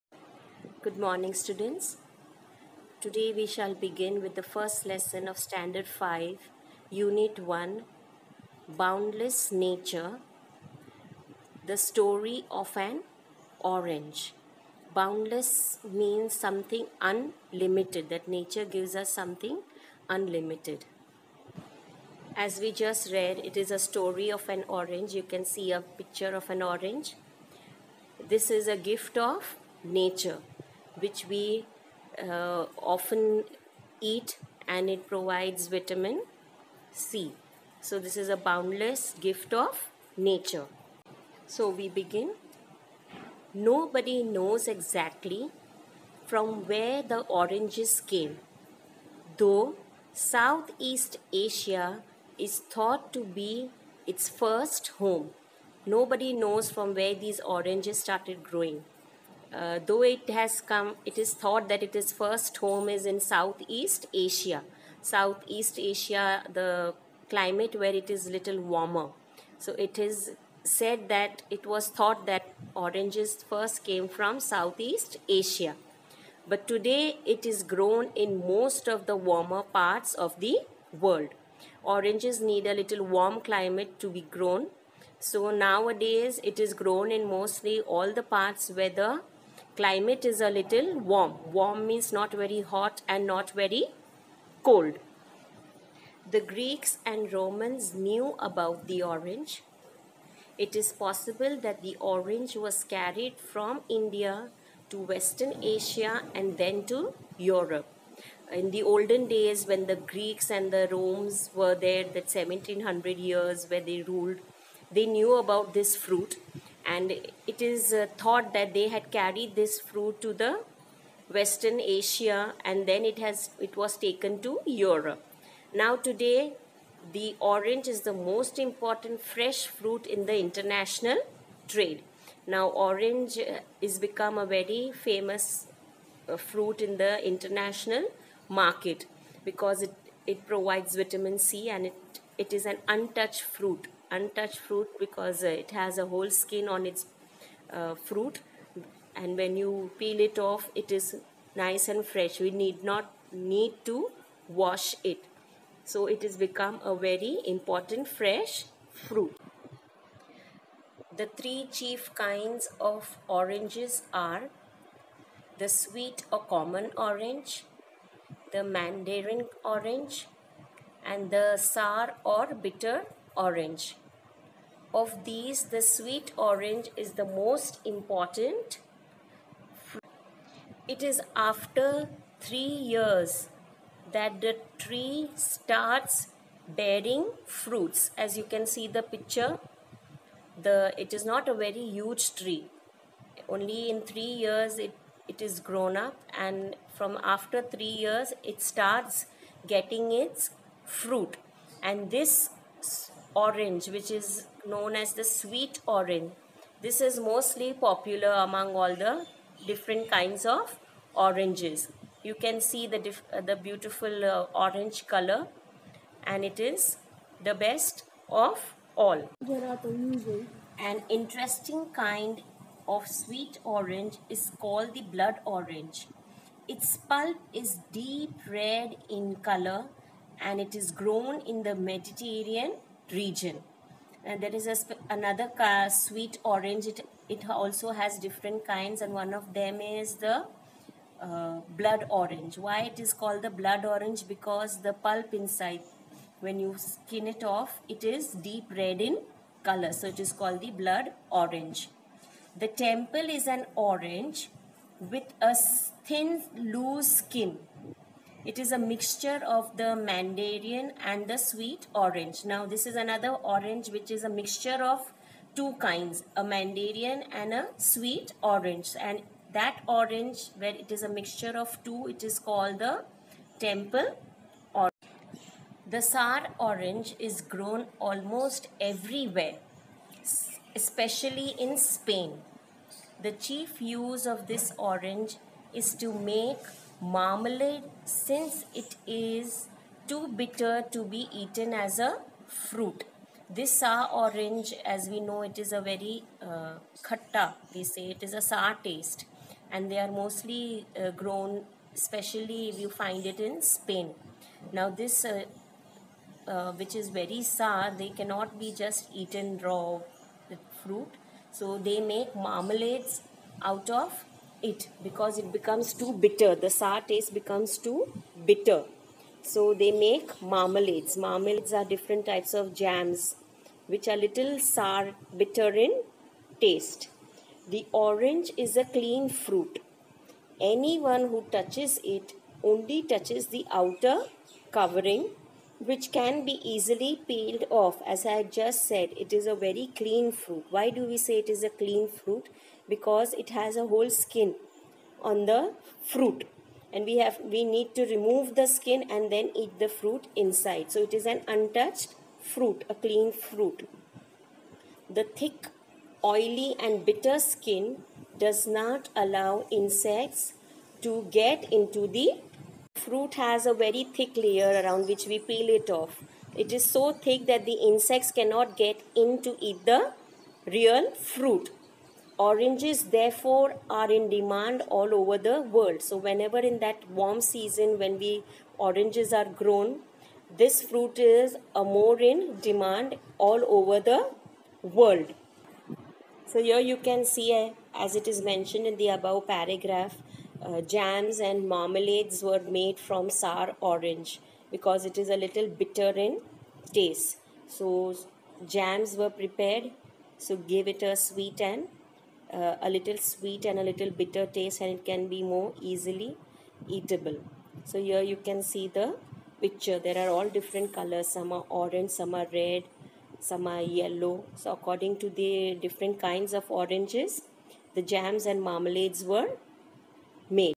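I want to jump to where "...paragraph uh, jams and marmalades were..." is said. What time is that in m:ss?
6:29.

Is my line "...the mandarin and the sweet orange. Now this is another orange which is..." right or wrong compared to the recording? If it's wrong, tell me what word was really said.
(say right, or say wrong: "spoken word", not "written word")
right.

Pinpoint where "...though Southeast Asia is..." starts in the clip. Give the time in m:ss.
0:49.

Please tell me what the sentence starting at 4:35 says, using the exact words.
The sour orange is grown almost everywhere, especially in Spain.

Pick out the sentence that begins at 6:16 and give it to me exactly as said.
So whenever in that warm season when we oranges are grown, this fruit is a more in demand all over the world.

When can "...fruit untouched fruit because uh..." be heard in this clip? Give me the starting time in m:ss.
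2:23.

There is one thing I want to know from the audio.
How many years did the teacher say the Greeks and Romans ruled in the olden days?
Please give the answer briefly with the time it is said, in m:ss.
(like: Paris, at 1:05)
1700, at 1:52.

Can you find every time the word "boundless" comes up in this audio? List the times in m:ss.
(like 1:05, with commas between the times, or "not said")
0:08, 0:14, 0:38.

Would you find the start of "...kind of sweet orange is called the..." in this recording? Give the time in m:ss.
3:41.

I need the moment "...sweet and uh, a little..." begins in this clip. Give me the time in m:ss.
6:41.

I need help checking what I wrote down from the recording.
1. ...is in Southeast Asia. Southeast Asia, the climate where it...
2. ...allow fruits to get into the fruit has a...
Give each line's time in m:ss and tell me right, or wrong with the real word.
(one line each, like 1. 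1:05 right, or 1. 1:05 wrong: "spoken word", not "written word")
1. 1:02 right
2. 5:59 wrong: "insects", not "fruits".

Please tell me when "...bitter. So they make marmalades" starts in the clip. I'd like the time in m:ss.
5:18.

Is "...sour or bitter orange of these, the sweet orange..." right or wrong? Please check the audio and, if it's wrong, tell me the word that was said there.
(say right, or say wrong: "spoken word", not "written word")
right.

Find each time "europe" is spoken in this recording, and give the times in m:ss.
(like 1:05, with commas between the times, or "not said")
1:47, 2:04.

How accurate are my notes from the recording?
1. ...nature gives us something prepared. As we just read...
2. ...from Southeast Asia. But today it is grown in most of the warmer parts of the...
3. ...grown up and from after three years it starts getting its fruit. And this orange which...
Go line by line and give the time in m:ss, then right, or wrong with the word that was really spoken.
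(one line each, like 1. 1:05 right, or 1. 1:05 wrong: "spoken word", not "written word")
1. 0:18 wrong: "unlimited", not "prepared"
2. 1:14 right
3. 3:15 right.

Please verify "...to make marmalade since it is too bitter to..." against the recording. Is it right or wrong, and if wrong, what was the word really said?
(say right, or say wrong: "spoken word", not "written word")
right.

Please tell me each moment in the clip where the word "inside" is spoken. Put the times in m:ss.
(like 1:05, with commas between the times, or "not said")
4:05, 5:50.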